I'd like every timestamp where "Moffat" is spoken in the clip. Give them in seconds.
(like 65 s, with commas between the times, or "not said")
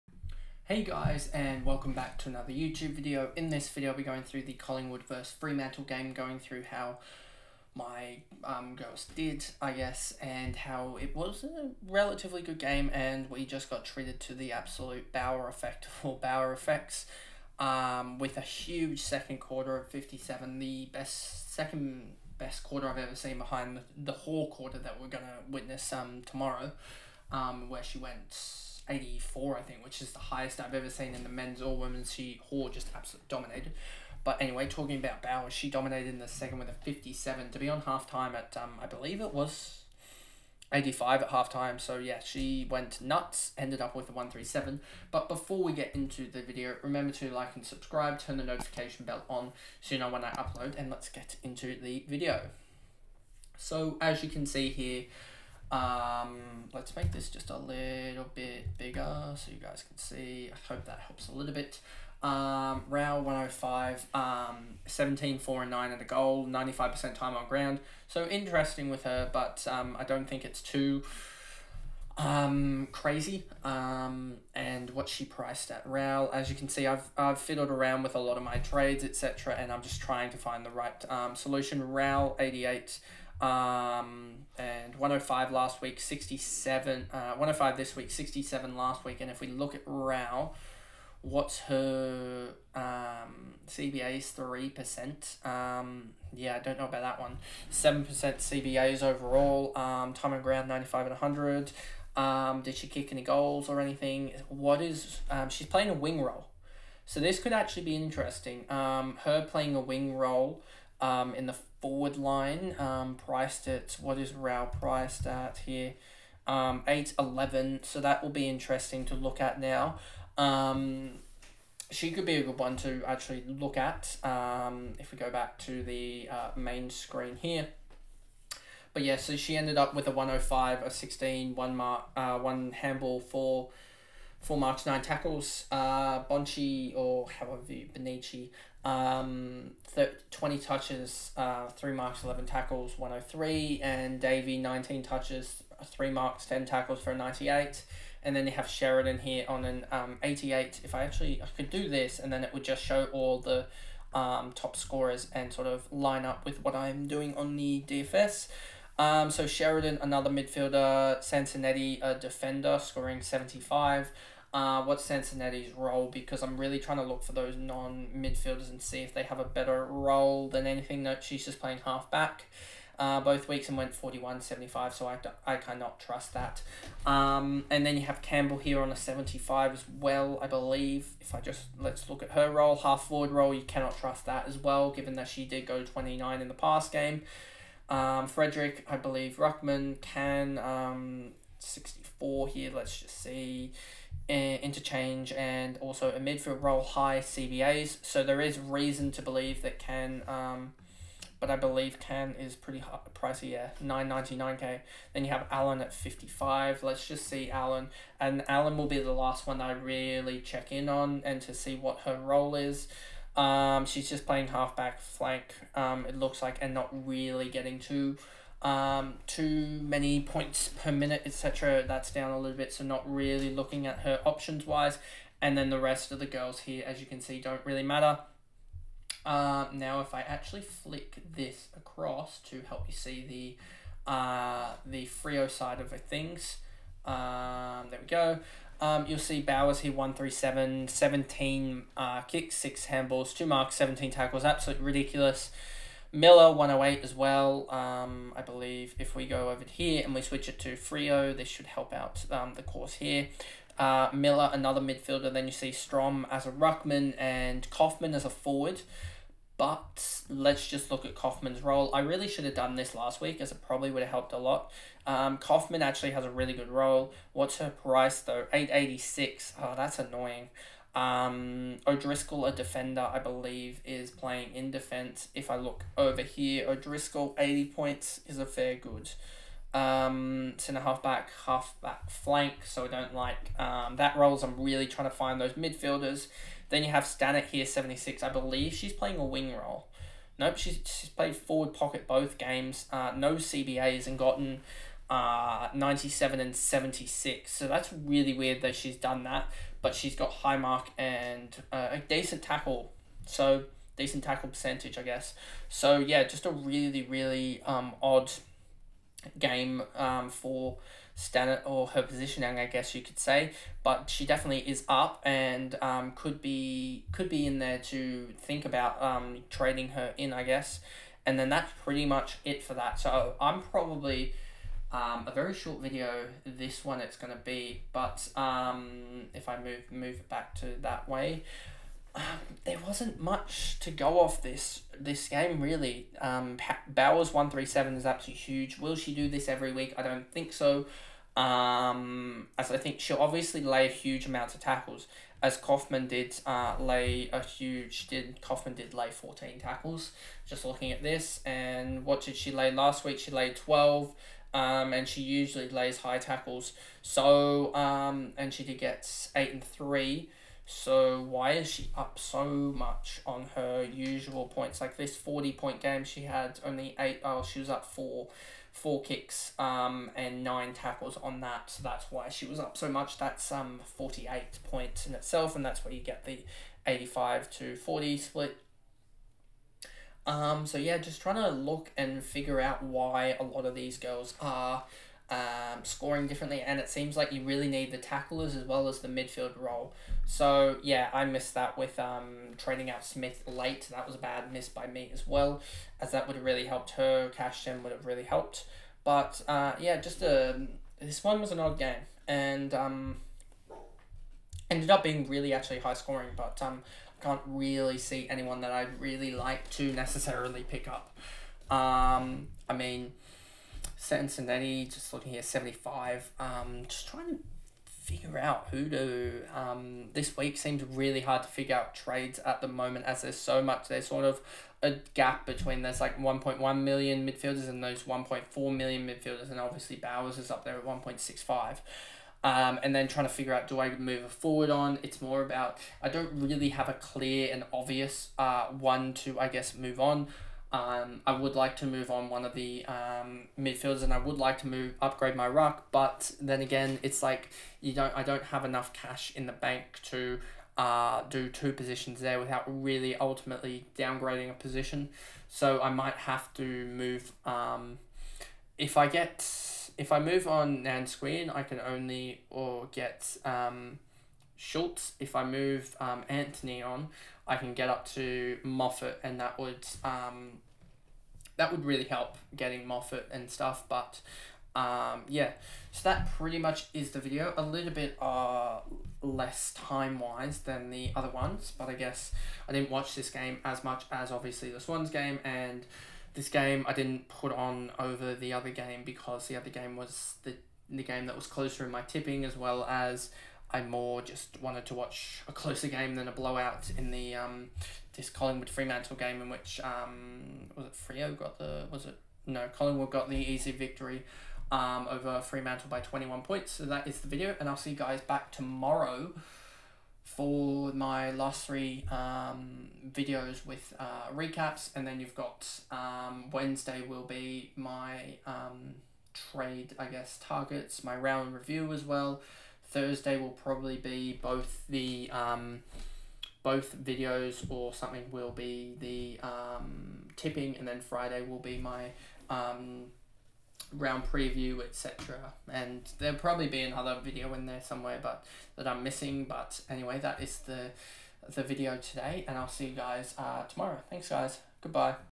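468 s, 472 s.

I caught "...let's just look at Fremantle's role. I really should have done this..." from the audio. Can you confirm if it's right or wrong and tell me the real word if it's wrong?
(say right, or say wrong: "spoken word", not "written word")
wrong: "Kaufman", not "Fremantle".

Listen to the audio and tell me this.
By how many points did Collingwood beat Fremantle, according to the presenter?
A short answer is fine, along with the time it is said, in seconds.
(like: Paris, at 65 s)
21, at 505 s.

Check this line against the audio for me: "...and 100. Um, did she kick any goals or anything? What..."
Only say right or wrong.
right.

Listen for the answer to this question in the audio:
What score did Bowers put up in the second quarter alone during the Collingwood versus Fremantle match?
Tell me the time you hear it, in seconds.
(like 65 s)
19 s.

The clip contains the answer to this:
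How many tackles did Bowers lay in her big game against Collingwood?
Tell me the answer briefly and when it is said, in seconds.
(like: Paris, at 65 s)
17, at 243 s.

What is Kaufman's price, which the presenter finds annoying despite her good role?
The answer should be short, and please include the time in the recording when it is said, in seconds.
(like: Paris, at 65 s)
886, at 268 s.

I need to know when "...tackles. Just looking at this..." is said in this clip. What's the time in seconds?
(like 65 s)
349 s.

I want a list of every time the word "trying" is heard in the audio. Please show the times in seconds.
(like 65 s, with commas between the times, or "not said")
80 s, 166 s, 284 s, 381 s, 417 s, 433 s.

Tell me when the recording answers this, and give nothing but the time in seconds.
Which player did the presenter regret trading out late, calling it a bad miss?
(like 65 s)
393 s.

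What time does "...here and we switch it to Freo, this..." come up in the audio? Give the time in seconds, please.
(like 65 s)
249 s.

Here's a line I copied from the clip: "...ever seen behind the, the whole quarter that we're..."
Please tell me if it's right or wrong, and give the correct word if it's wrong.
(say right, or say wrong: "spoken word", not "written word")
right.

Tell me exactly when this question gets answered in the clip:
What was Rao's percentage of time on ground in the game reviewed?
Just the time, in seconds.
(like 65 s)
66 s.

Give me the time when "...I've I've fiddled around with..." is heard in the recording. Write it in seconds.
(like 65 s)
76 s.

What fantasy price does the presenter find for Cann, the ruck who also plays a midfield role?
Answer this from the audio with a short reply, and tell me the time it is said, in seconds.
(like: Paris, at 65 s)
999k, at 203 s.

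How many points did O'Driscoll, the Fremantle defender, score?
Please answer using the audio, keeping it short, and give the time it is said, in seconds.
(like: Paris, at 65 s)
80, at 277 s.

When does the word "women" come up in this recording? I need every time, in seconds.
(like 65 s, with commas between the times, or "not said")
31 s.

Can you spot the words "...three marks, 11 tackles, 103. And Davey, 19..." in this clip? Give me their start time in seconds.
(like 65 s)
141 s.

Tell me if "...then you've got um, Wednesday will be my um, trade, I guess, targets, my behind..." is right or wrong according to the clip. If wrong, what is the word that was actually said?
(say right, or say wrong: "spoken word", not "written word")
wrong: "round", not "behind".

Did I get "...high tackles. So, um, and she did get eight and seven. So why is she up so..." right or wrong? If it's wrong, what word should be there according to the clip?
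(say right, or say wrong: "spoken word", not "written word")
wrong: "three", not "seven".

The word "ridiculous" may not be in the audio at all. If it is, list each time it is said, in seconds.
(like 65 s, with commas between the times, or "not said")
244 s.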